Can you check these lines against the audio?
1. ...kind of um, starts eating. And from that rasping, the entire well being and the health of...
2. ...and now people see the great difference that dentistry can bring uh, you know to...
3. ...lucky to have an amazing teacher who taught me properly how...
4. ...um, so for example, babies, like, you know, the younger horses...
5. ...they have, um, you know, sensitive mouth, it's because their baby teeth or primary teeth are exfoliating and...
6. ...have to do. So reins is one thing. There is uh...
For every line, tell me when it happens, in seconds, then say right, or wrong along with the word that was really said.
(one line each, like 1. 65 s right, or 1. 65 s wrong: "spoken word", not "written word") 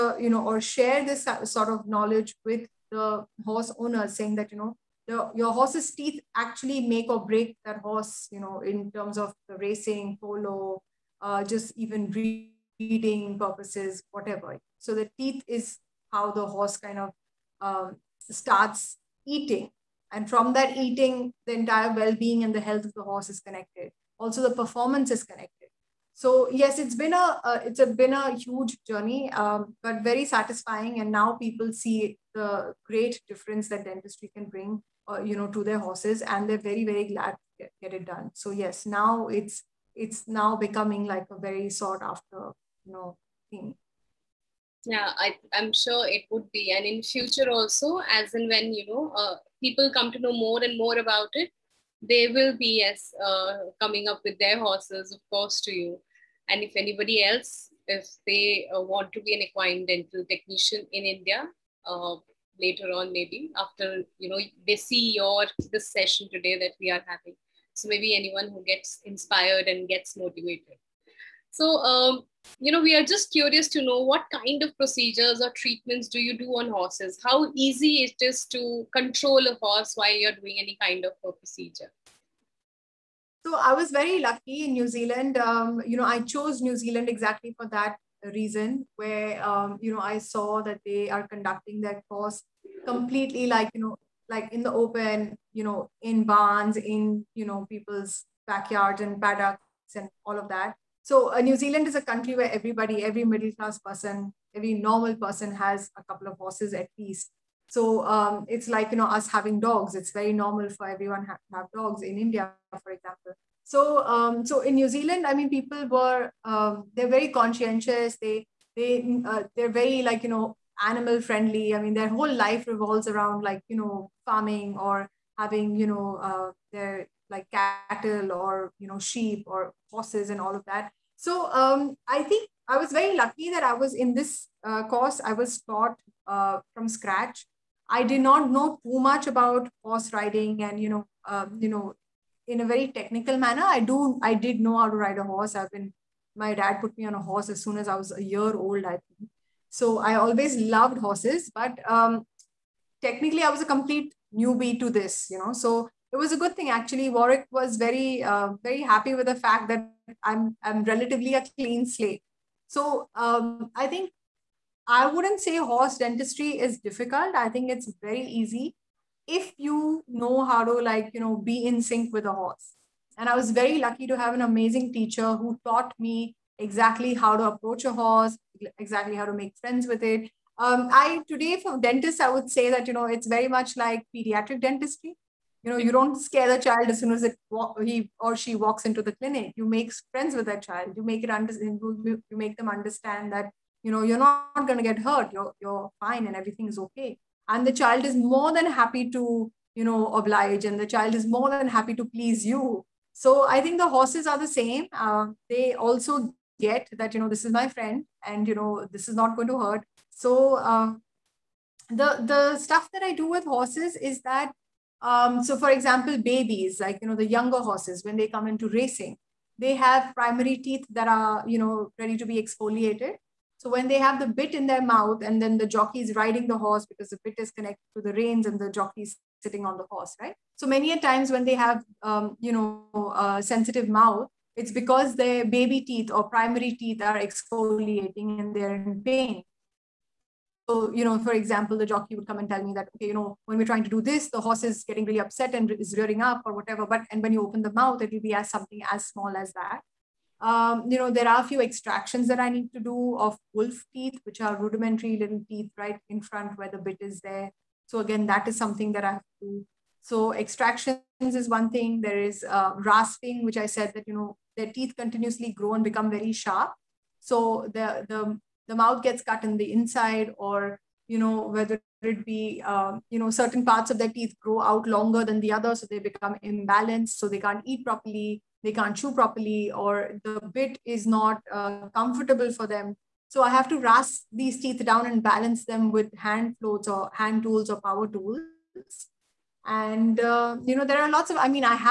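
1. 16 s wrong: "eating", not "rasping"
2. 30 s right
3. 173 s wrong: "exactly", not "properly"
4. 215 s right
5. 231 s right
6. 259 s wrong: "extractions", not "reins".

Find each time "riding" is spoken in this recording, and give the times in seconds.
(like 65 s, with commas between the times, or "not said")
140 s, 226 s.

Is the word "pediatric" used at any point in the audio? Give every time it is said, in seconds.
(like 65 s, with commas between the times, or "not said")
184 s.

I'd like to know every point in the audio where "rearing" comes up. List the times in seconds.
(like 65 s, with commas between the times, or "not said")
245 s.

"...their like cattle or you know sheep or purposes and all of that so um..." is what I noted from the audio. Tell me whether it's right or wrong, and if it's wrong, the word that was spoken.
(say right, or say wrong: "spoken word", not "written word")
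wrong: "horses", not "purposes".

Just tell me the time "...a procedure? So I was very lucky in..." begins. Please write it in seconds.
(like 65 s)
81 s.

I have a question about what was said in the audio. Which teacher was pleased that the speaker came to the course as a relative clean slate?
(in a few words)
Warwick.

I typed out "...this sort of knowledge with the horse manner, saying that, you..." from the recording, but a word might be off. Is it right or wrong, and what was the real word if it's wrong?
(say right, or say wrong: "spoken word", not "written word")
wrong: "owner", not "manner".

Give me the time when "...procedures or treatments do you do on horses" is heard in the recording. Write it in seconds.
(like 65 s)
74 s.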